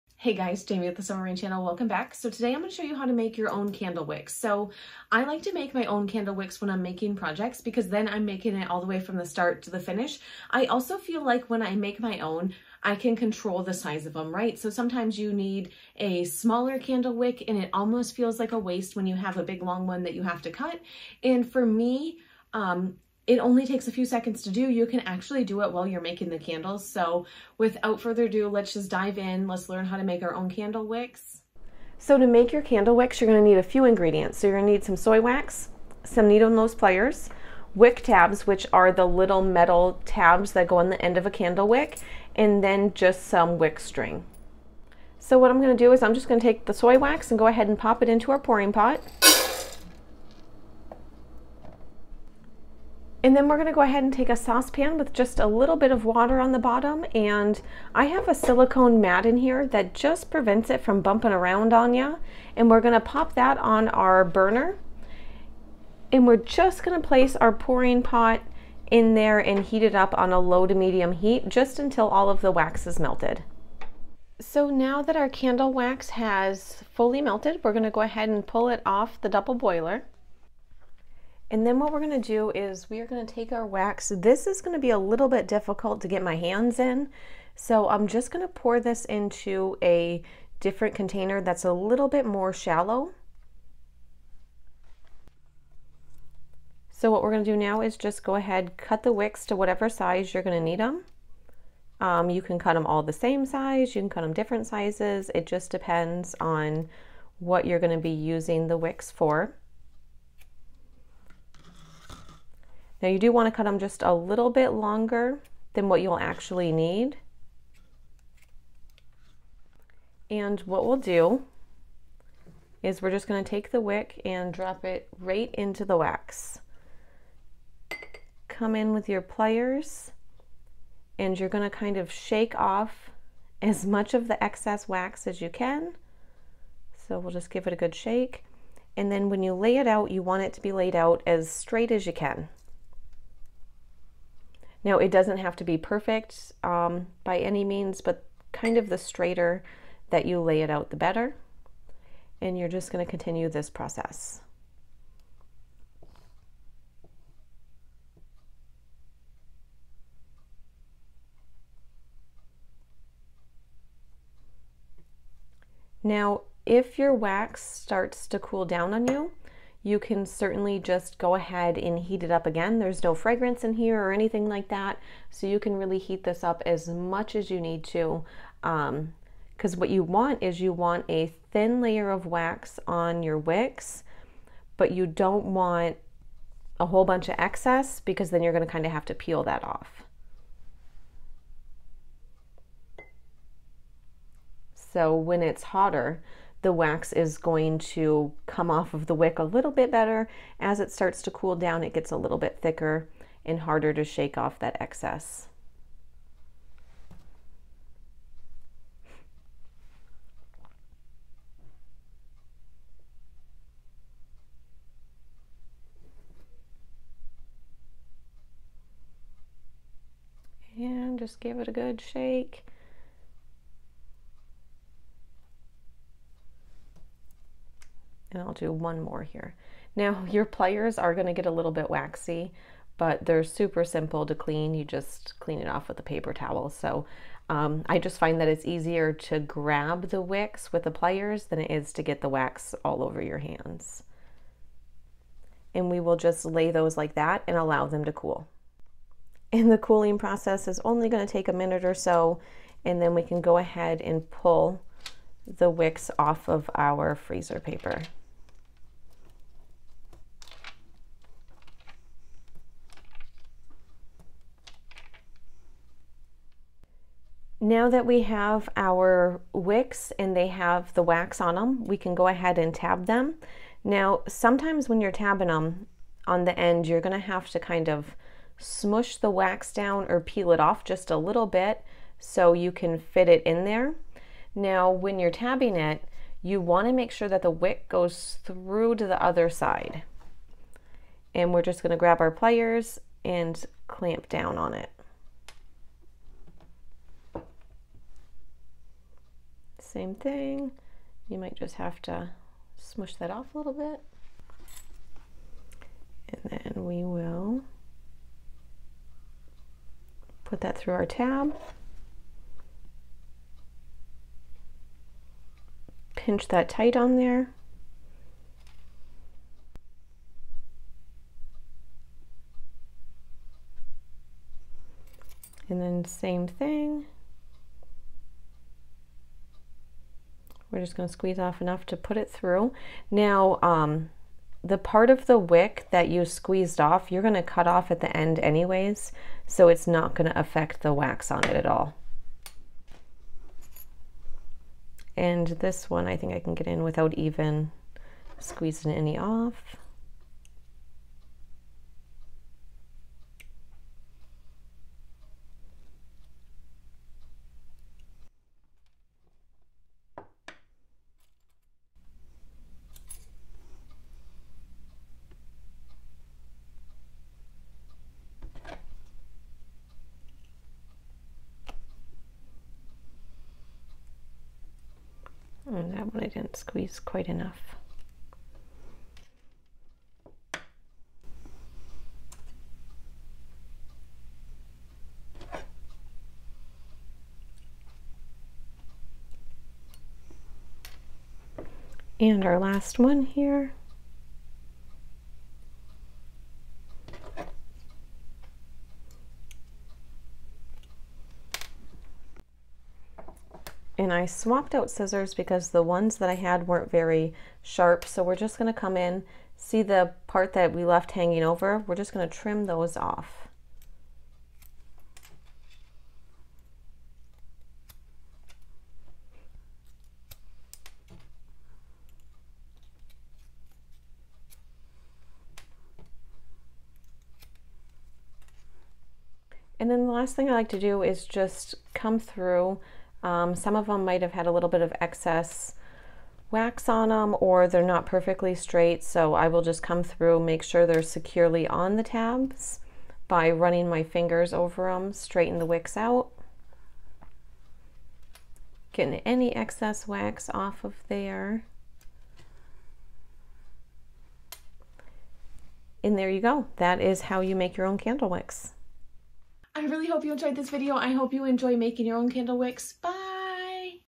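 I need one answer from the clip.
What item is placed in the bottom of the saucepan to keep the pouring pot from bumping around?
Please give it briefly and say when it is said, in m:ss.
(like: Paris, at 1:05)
Silicone mat, at 0:58.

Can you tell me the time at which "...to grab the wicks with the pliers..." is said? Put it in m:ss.
3:59.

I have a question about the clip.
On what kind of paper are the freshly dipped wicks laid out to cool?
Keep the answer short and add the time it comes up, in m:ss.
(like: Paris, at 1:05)
Freezer paper, at 4:17.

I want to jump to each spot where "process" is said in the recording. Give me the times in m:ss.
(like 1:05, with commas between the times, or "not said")
2:33, 4:10.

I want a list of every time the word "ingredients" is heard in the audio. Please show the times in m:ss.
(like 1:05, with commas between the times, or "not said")
0:33.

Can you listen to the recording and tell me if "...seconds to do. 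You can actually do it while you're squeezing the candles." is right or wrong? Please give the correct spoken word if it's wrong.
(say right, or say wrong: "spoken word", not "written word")
wrong: "making", not "squeezing".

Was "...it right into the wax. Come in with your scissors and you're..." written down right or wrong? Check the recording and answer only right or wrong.
wrong.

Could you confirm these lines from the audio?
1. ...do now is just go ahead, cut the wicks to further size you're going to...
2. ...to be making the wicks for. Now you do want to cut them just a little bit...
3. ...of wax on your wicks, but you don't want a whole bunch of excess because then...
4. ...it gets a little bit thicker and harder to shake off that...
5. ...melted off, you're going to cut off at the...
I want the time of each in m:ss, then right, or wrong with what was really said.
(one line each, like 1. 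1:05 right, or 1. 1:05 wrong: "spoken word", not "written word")
1. 1:37 wrong: "whatever", not "further"
2. 1:47 wrong: "using", not "making"
3. 3:02 right
4. 3:21 right
5. 5:36 wrong: "squeezed", not "melted".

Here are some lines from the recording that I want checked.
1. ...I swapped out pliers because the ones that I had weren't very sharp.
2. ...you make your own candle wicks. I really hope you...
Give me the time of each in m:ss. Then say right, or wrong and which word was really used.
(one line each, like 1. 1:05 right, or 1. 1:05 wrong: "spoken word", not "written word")
1. 6:44 wrong: "scissors", not "pliers"
2. 7:37 right.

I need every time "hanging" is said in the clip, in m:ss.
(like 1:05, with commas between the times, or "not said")
6:51.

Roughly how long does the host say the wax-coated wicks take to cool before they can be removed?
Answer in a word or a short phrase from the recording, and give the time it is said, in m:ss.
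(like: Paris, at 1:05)
A minute or so, at 4:11.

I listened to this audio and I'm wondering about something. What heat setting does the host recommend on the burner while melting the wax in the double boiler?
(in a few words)
Low to medium.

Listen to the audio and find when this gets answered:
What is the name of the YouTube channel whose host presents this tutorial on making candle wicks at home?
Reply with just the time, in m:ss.
0:01.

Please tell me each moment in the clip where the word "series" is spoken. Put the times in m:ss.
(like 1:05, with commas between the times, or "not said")
not said.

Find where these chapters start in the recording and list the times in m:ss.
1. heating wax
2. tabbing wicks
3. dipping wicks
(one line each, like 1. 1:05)
1. 0:45
2. 4:34
3. 1:56.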